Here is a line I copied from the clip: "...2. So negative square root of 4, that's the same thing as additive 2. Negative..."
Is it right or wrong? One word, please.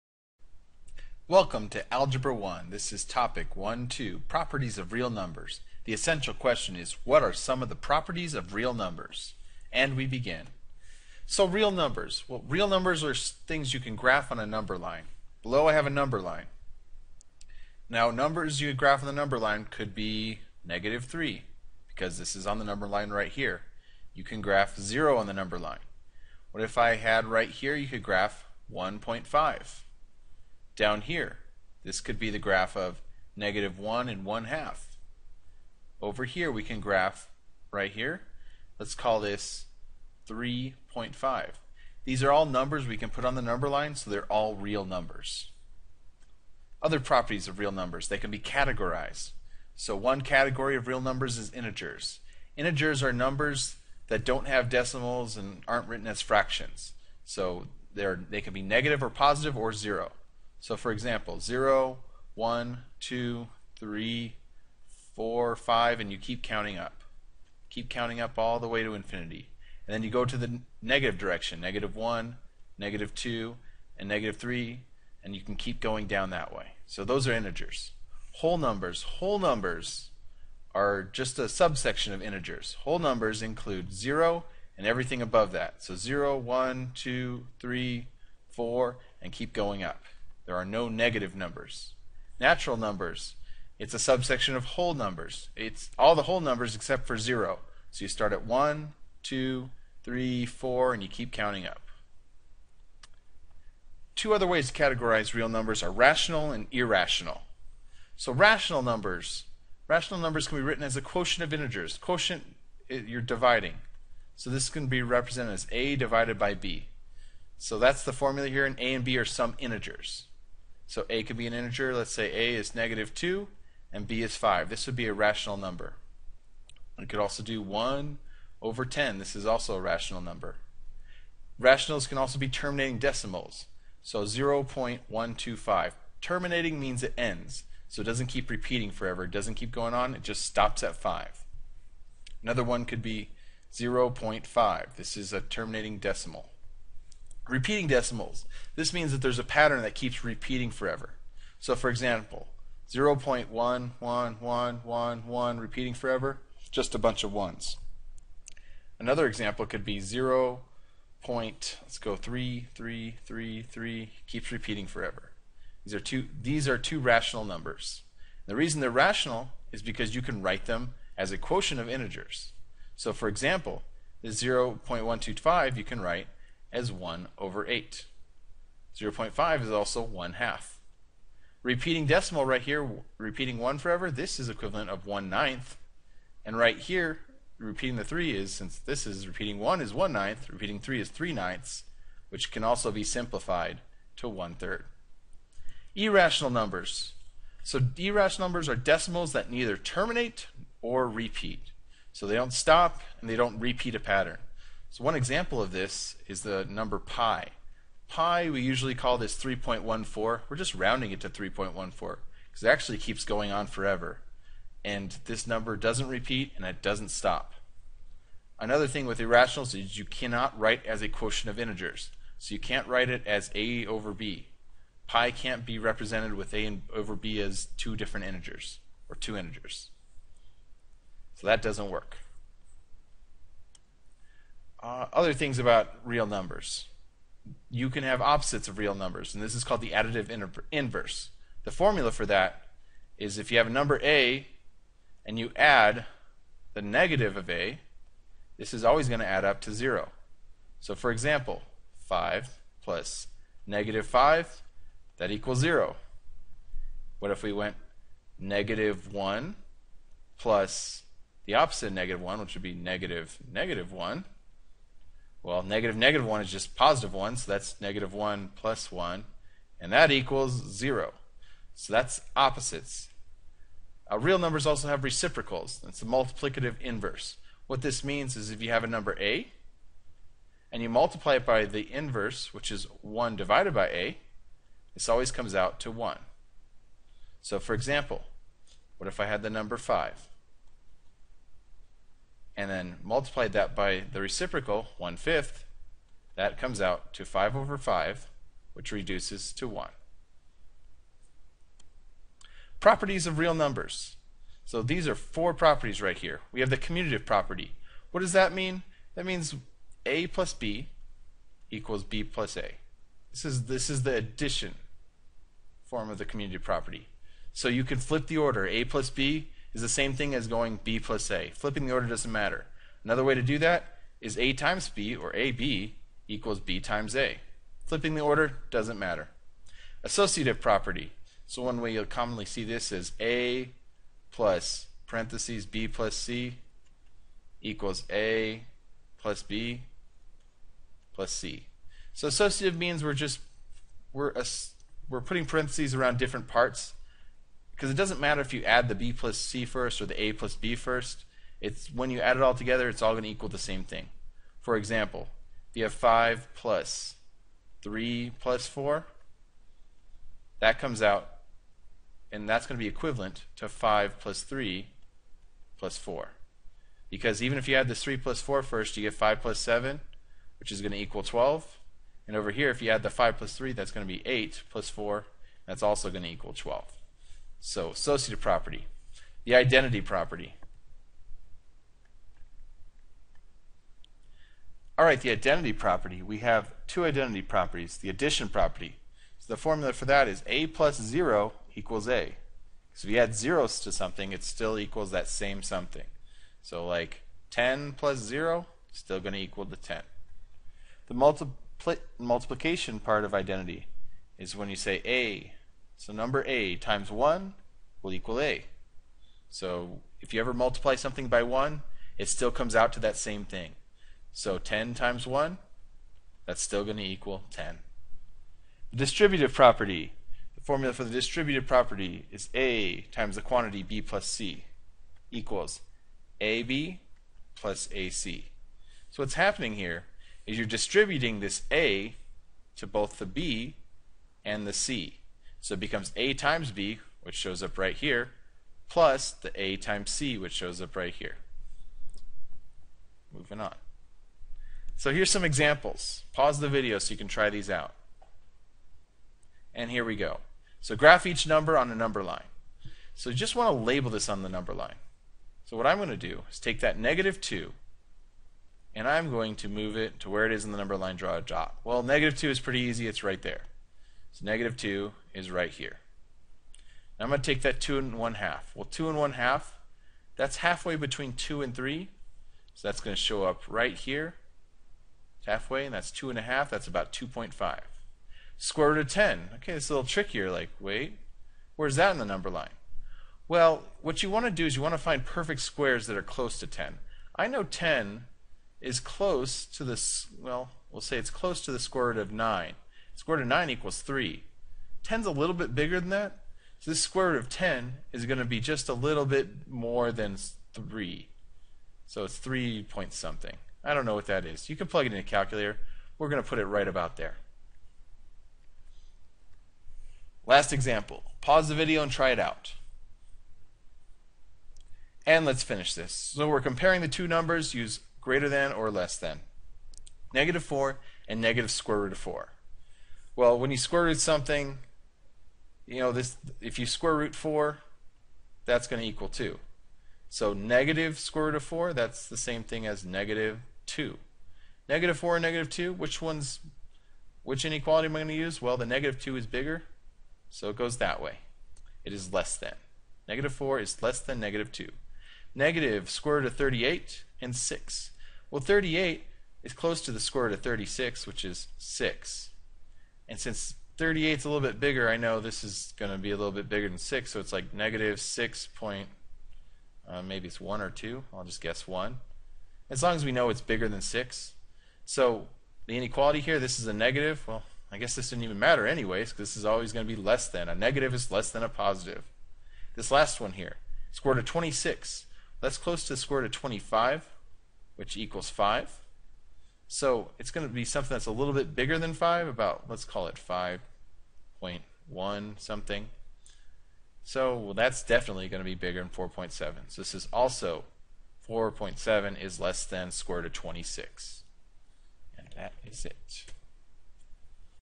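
wrong.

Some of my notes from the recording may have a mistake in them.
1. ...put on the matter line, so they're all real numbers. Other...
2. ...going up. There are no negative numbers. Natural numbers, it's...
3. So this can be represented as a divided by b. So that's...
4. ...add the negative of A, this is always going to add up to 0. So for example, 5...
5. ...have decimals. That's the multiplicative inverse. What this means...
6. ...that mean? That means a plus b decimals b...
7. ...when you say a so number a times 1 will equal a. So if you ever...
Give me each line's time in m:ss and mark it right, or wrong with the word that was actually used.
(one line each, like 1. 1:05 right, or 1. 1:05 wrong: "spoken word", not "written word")
1. 0:43 wrong: "number", not "matter"
2. 1:29 right
3. 1:54 right
4. 4:05 right
5. 4:34 wrong: "reciprocals", not "decimals"
6. 5:08 wrong: "equals", not "decimals"
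7. 6:44 right.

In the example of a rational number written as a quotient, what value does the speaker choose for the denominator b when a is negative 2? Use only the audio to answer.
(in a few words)
5.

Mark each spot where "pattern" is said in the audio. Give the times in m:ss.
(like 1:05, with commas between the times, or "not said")
2:29, 3:23.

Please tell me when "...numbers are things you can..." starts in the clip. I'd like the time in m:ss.
0:12.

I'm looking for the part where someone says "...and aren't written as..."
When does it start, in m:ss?
0:55.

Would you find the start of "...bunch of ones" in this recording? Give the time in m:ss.
2:36.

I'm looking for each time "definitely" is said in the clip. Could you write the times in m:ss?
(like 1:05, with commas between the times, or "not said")
9:48.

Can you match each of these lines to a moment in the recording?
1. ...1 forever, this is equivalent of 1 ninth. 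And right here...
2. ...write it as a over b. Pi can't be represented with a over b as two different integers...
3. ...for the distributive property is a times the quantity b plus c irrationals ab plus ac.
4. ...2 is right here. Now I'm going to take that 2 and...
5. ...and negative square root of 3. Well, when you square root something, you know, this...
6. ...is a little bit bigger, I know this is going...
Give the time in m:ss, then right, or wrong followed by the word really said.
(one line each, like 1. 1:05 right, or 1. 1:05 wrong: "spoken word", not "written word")
1. 3:03 right
2. 3:42 right
3. 7:00 wrong: "equals", not "irrationals"
4. 7:44 right
5. 8:41 wrong: "4", not "3"
6. 9:14 right.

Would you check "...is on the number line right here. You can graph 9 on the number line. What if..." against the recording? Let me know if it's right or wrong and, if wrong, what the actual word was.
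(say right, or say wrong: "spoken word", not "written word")
wrong: "0", not "9".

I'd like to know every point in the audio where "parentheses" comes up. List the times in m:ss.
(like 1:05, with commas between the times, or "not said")
5:35, 5:45.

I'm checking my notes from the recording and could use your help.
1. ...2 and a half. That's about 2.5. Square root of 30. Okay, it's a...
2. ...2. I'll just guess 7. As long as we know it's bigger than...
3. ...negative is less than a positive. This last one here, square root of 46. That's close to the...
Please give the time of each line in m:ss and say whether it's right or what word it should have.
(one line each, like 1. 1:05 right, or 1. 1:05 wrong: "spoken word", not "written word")
1. 7:56 wrong: "10", not "30"
2. 9:20 wrong: "1", not "7"
3. 9:30 wrong: "26", not "46".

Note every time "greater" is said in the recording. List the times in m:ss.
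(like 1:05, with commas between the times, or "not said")
8:38.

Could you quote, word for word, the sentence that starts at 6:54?
So 10 times 1, that's still going to equal 10.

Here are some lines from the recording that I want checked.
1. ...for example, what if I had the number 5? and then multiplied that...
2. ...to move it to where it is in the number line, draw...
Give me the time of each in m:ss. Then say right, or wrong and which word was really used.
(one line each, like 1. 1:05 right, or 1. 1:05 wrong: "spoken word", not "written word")
1. 4:47 right
2. 7:39 right.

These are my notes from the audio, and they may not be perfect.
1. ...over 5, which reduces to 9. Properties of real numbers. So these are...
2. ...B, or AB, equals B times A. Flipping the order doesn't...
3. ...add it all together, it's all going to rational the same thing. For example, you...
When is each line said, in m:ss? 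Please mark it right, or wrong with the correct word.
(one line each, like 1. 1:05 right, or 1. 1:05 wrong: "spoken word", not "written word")
1. 4:57 wrong: "1", not "9"
2. 5:24 right
3. 5:52 wrong: "equal", not "rational".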